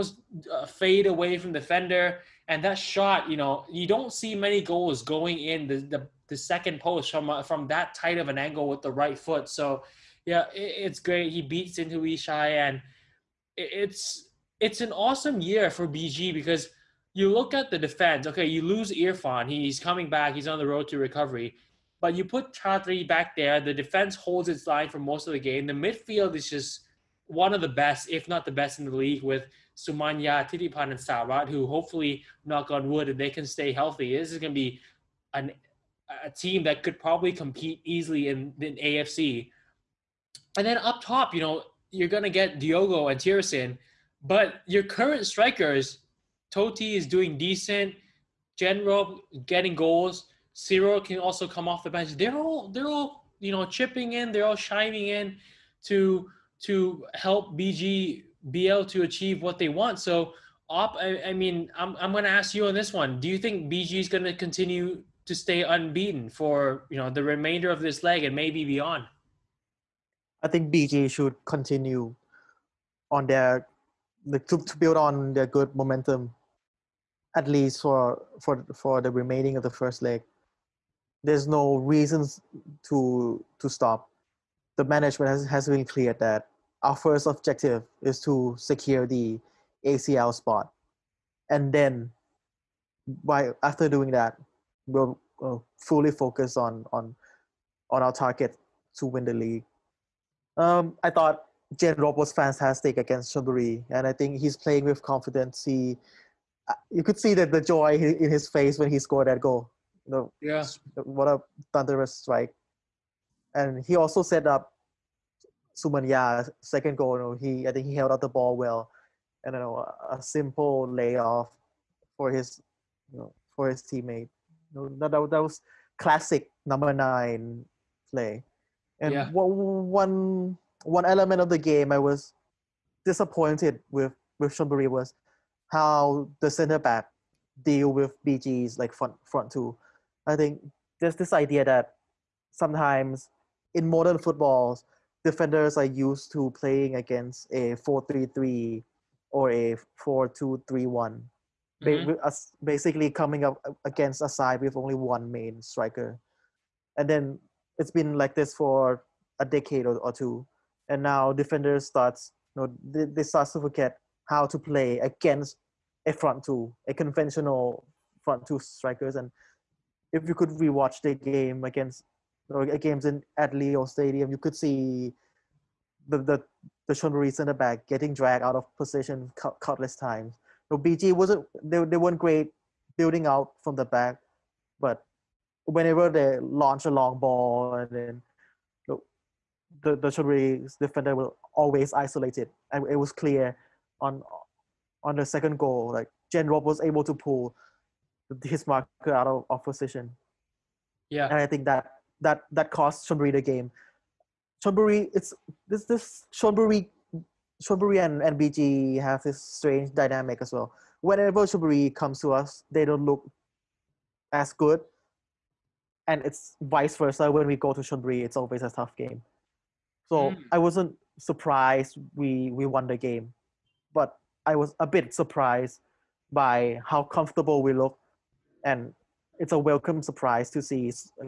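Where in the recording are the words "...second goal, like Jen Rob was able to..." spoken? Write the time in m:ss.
3:15.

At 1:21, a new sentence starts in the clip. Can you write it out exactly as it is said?
There's no reasons to to stop.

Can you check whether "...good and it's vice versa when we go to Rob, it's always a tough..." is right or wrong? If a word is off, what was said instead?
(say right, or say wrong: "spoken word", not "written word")
wrong: "Chonburi", not "Rob".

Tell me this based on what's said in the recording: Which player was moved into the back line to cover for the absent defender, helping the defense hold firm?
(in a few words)
Chatri.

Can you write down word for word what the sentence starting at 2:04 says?
You know, that, that was classic number nine play.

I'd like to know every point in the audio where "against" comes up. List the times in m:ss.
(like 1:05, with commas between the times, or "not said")
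1:42, 2:26, 2:33, 2:44, 2:51.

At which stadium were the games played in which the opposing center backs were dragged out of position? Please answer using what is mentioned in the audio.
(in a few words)
Leo Stadium.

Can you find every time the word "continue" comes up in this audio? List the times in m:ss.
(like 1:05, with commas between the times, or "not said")
1:04, 1:11.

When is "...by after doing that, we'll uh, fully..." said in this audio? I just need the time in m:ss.
1:33.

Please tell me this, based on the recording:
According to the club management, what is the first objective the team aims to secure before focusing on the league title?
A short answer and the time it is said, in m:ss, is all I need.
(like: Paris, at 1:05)
ACL spot, at 1:29.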